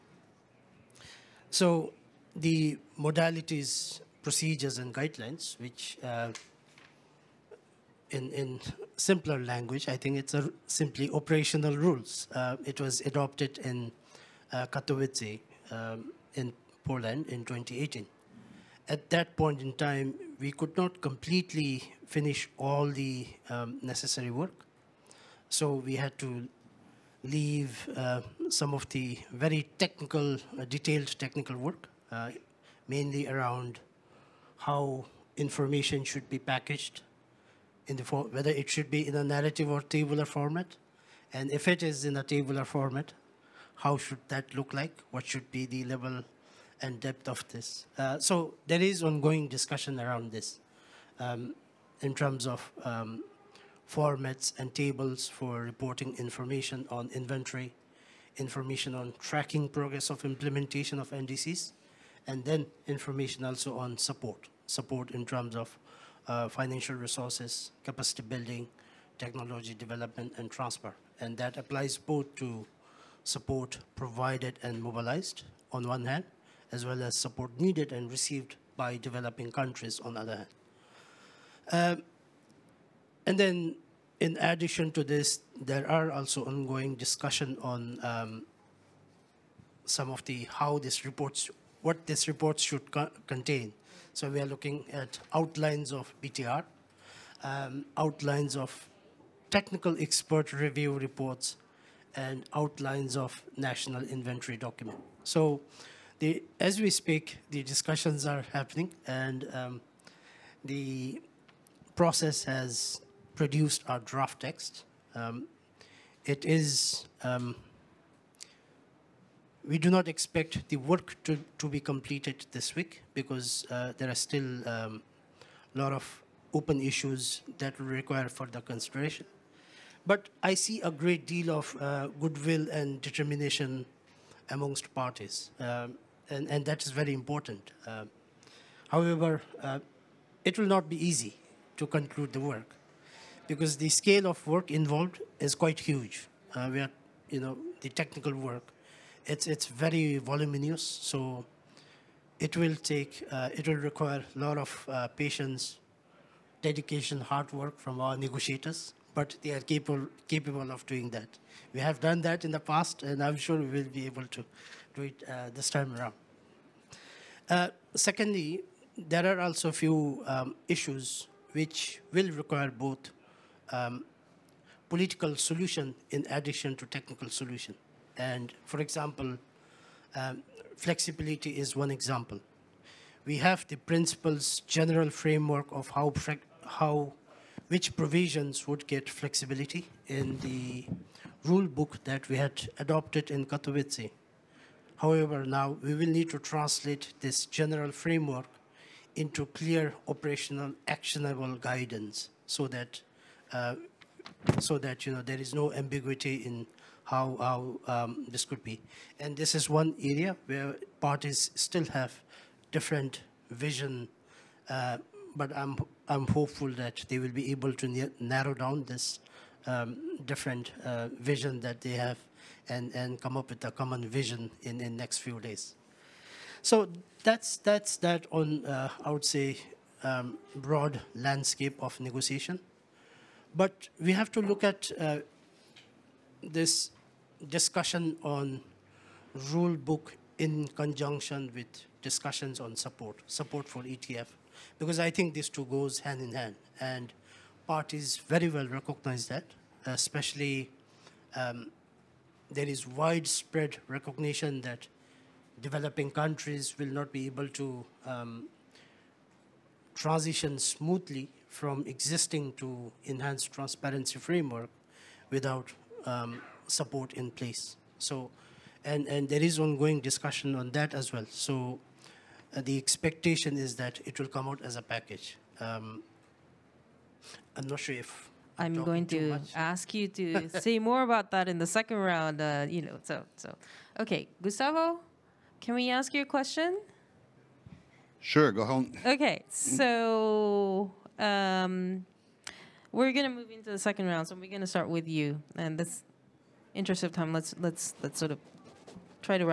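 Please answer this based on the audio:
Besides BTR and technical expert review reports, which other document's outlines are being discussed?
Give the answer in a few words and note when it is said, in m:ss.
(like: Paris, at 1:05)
National inventory document, at 1:43.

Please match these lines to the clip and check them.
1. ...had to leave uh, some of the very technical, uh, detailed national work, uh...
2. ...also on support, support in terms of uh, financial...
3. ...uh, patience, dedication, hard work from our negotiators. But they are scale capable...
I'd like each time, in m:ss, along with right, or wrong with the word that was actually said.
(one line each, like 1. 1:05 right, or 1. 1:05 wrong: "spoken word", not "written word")
1. 0:25 wrong: "technical", not "national"
2. 1:03 right
3. 2:34 wrong: "capable", not "scale".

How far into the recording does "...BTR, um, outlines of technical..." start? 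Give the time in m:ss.
1:36.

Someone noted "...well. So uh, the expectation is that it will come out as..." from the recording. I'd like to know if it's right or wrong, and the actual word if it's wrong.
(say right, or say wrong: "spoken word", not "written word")
right.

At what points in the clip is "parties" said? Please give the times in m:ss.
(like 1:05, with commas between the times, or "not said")
2:14, 3:30, 4:07.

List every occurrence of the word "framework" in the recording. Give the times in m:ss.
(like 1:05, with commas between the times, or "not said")
3:05, 3:17, 4:24.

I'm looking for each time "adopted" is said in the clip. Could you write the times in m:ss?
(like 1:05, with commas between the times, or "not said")
0:13, 3:12.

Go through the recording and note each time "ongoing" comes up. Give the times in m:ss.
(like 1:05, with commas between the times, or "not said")
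0:49, 1:26, 4:29.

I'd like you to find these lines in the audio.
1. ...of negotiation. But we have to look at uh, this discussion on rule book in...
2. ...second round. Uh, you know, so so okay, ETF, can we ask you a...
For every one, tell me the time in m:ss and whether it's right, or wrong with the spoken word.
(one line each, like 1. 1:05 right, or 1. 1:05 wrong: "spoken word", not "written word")
1. 3:51 right
2. 4:41 wrong: "Gustavo", not "ETF".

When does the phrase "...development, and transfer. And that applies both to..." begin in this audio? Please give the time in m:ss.
1:09.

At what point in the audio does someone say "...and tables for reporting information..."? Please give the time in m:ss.
0:54.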